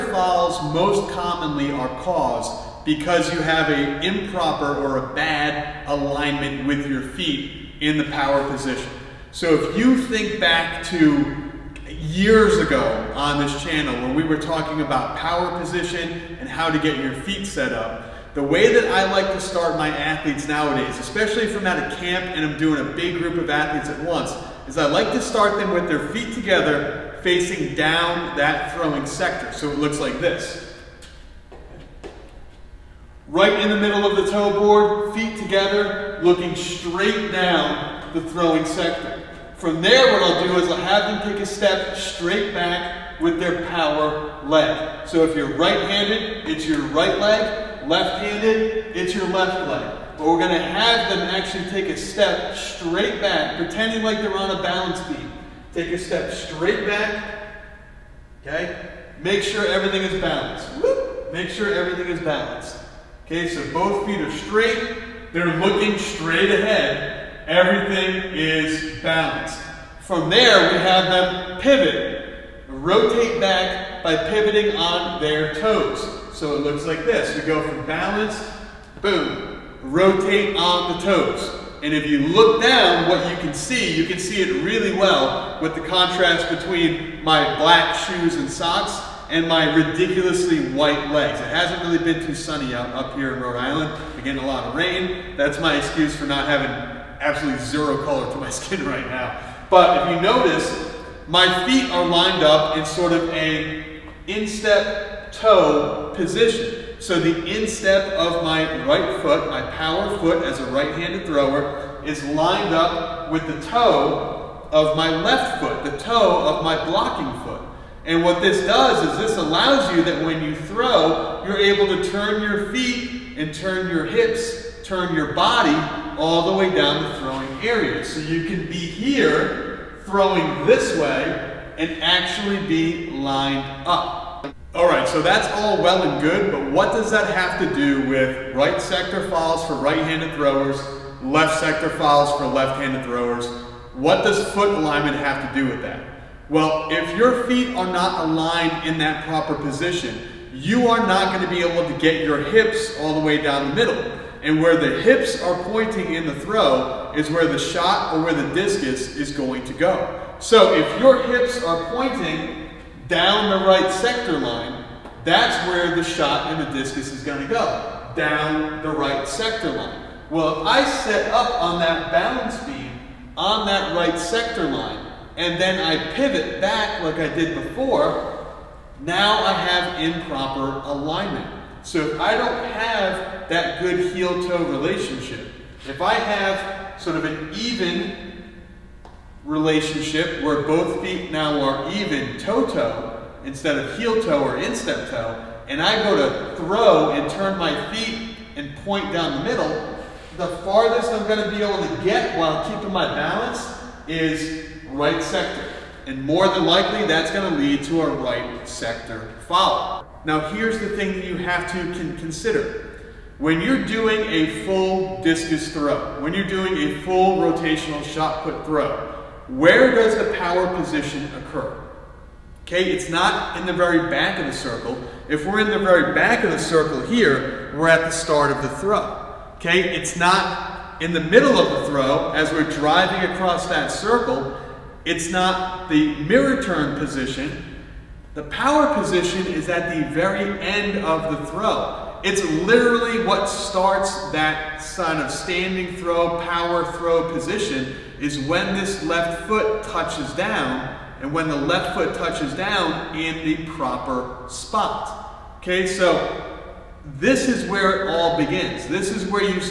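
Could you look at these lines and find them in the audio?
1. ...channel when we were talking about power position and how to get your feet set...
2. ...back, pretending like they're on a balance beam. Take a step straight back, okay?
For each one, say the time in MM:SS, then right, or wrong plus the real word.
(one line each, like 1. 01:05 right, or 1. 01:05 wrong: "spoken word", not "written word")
1. 00:13 right
2. 00:53 right.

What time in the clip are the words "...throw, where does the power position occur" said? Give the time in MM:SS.
03:38.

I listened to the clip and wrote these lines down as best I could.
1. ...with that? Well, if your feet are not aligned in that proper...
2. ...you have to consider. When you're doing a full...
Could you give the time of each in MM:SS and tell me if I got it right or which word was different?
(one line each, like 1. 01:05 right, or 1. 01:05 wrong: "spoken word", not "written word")
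1. 02:25 right
2. 03:31 right.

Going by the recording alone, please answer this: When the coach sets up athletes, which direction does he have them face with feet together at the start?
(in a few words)
Down the throwing sector.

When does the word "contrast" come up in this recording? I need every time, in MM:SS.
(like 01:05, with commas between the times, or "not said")
01:25.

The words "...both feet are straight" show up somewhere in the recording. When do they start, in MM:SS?
01:03.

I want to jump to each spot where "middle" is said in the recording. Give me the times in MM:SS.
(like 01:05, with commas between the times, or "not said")
00:33, 02:33, 03:19, 03:51.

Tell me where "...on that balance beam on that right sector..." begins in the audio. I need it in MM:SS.
02:51.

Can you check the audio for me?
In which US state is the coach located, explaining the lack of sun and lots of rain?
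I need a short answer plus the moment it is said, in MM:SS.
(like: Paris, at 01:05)
Rhode Island, at 01:33.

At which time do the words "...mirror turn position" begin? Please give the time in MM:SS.
03:56.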